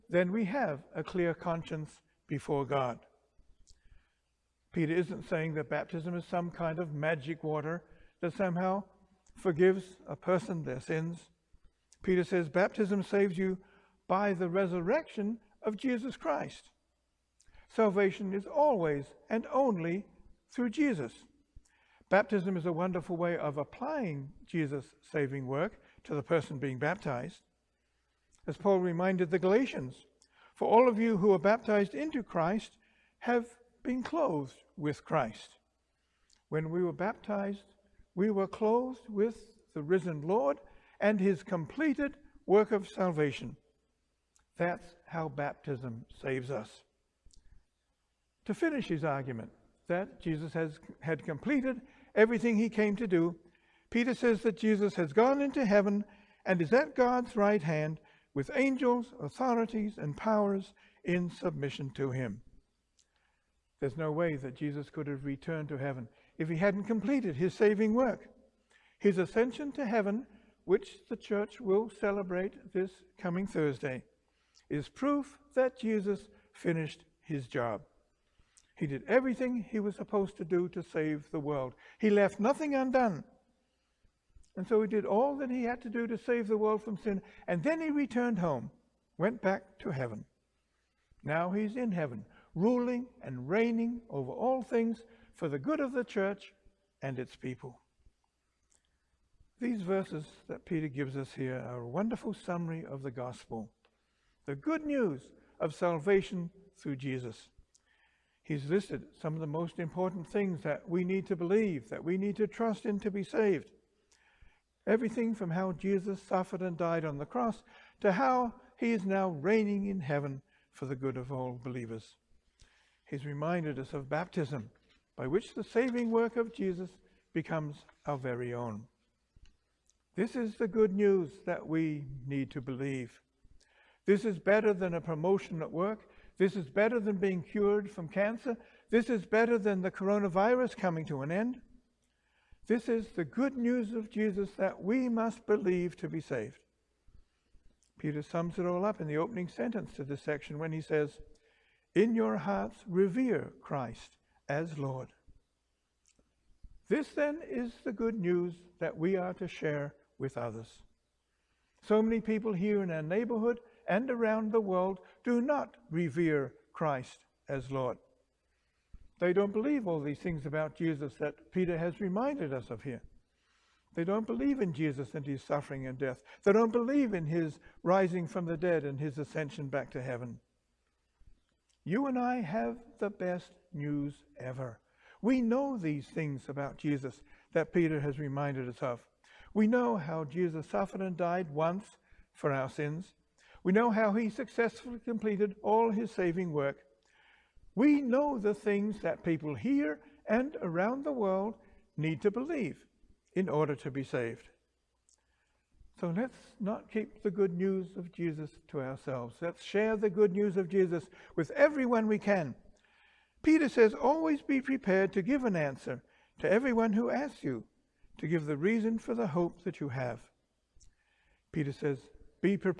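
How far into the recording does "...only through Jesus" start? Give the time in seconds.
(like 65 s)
19 s.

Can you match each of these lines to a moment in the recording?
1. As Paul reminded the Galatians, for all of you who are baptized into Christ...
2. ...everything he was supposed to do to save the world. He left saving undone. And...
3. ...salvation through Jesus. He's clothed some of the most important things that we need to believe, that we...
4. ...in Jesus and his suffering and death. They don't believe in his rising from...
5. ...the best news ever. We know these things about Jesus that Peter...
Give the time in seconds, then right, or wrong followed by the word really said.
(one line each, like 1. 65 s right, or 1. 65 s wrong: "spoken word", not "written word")
1. 28 s right
2. 79 s wrong: "nothing", not "saving"
3. 105 s wrong: "listed", not "clothed"
4. 174 s right
5. 183 s right.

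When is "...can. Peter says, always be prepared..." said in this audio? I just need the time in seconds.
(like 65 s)
212 s.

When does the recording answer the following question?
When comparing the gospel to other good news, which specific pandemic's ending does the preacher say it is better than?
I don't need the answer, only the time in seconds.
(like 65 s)
139 s.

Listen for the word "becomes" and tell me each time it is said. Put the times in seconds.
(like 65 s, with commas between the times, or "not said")
127 s.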